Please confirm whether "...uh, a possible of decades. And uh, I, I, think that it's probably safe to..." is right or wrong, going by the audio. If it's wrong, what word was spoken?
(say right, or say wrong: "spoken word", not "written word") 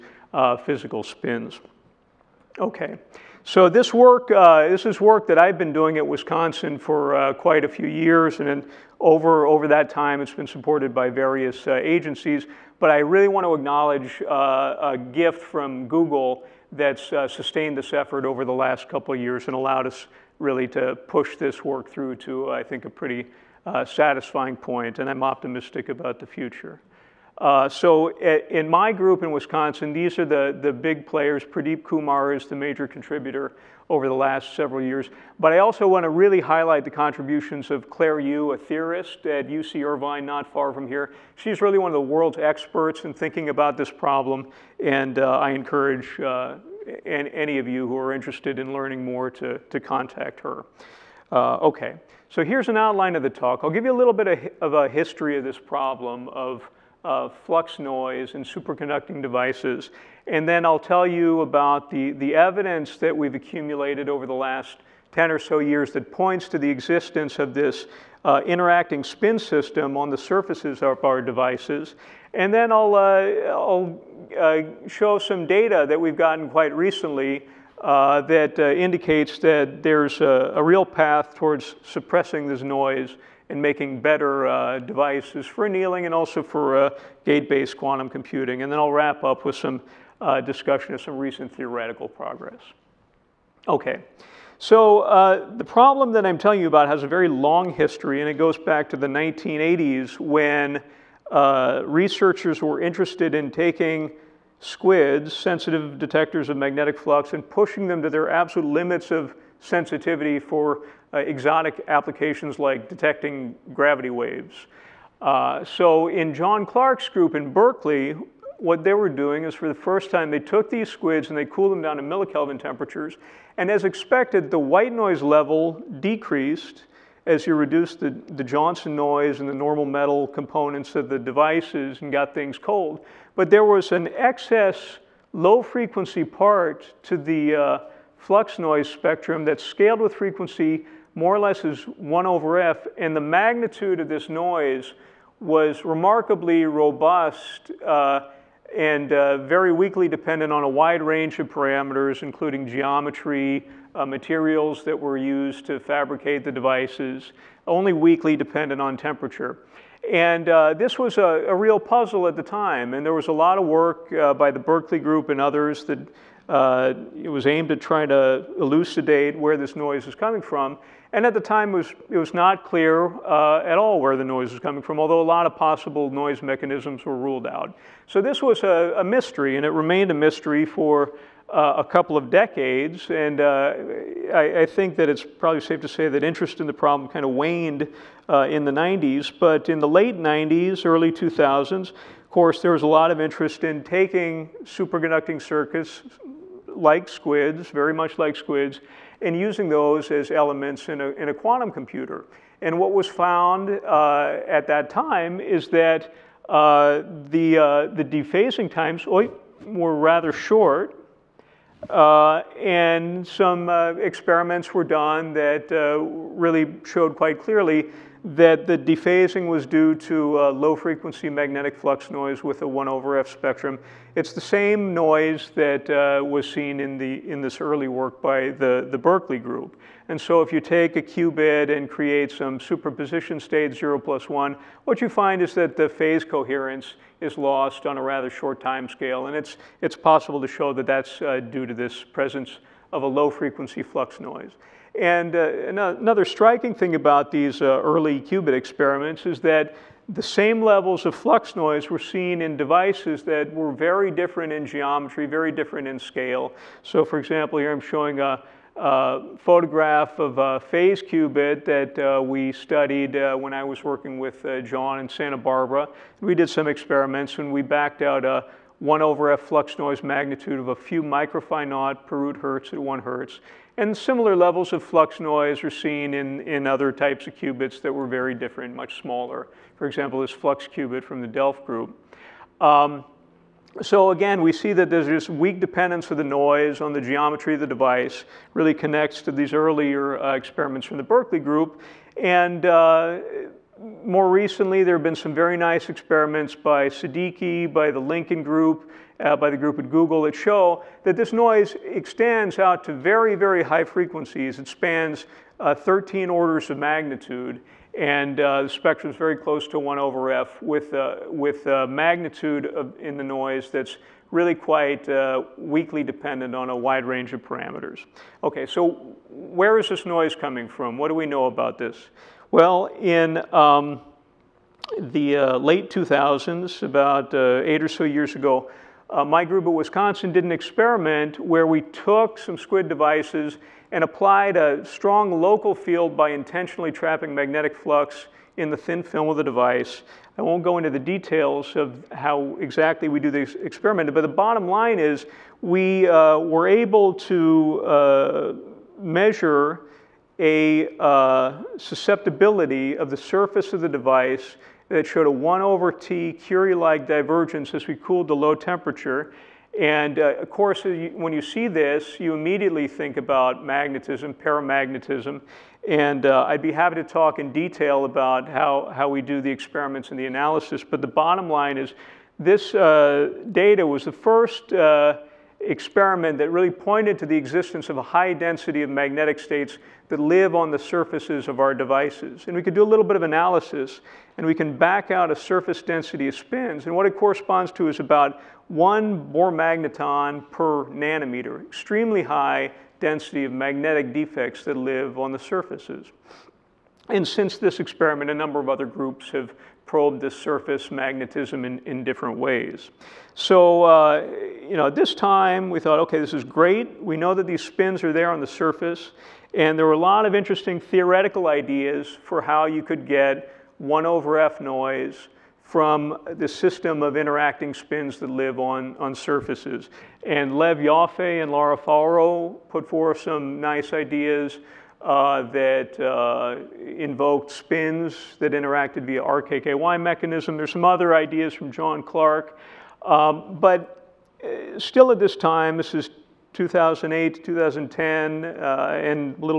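wrong: "couple", not "possible".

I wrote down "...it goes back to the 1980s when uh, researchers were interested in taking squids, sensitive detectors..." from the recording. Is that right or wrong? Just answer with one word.
right.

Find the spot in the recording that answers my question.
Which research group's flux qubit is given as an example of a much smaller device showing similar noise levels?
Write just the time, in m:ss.
4:41.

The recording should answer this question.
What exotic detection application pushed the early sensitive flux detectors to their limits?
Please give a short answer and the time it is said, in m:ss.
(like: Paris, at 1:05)
Gravity waves, at 1:53.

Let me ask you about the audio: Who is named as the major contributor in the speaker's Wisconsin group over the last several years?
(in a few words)
Pradeep Kumar.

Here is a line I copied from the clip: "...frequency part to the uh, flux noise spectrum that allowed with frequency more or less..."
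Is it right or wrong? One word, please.
wrong.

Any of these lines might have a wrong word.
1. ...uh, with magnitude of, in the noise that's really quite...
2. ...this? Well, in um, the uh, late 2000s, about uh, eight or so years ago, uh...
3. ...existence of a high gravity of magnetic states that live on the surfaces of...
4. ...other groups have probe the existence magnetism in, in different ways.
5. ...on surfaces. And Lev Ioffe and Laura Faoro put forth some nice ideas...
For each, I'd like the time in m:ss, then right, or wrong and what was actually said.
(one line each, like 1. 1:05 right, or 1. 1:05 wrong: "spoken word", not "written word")
1. 5:10 right
2. 5:21 right
3. 6:17 wrong: "density", not "gravity"
4. 6:38 wrong: "surface", not "existence"
5. 6:58 right.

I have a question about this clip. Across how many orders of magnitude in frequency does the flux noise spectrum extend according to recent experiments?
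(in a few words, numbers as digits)
13.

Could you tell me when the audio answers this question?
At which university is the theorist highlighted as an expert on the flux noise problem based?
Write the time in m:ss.
0:39.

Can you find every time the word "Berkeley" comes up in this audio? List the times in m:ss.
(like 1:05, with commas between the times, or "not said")
1:57, 2:44, 3:48, 4:51.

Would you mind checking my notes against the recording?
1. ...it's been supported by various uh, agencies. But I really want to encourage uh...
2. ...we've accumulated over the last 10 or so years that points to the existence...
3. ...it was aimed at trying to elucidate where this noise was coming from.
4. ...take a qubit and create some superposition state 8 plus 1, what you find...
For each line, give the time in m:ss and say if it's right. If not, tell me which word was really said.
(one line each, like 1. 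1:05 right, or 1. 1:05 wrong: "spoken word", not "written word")
1. 0:10 wrong: "acknowledge", not "encourage"
2. 1:03 right
3. 2:47 right
4. 3:50 wrong: "0", not "8".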